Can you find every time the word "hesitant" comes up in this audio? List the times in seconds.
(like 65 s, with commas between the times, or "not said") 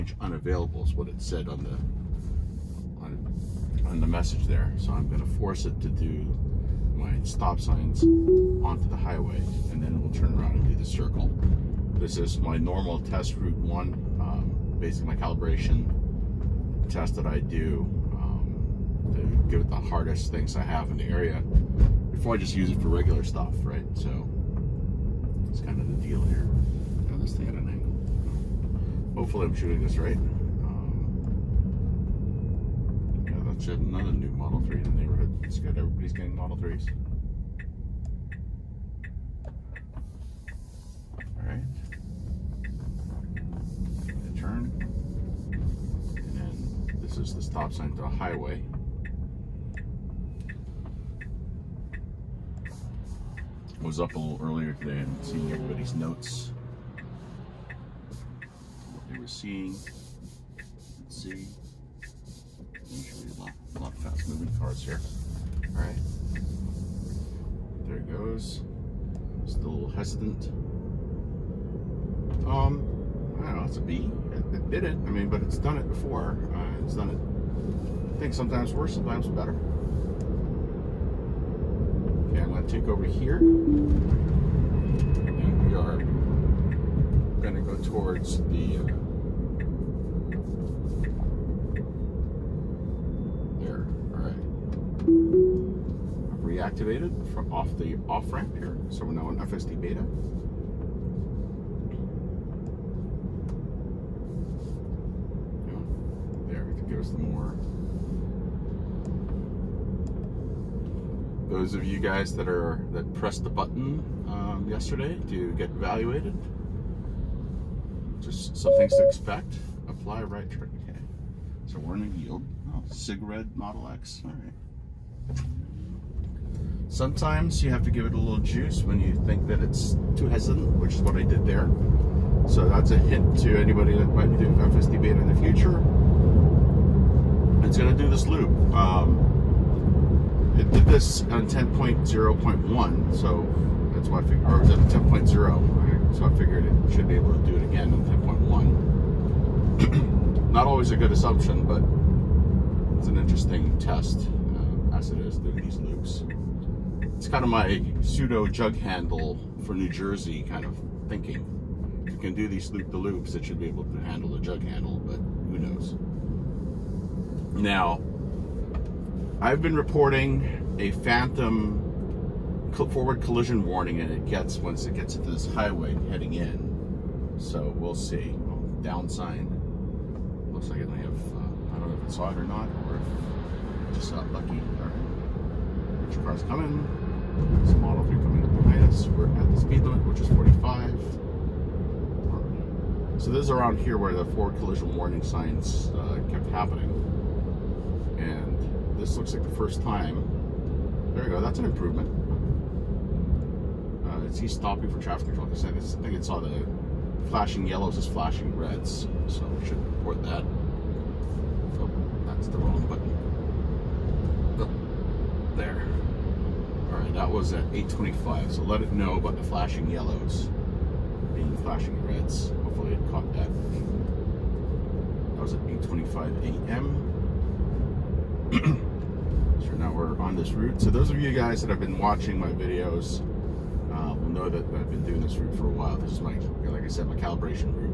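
69 s, 130 s.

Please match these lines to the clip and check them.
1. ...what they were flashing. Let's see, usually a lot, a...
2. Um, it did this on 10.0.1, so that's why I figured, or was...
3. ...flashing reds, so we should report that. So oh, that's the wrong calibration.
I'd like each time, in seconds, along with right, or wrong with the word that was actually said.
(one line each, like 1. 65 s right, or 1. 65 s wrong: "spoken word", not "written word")
1. 58 s wrong: "seeing", not "flashing"
2. 138 s right
3. 208 s wrong: "button", not "calibration".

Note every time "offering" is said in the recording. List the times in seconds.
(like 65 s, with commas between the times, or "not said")
not said.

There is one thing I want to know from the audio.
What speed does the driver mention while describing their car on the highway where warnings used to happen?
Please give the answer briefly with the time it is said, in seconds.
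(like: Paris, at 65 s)
45, at 190 s.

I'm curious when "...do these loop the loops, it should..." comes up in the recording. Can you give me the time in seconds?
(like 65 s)
162 s.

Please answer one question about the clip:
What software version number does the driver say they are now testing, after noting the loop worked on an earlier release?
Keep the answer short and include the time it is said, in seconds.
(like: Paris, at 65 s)
10.1, at 149 s.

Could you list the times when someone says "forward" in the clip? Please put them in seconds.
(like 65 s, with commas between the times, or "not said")
172 s, 194 s.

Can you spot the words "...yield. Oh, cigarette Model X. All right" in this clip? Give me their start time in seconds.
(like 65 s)
122 s.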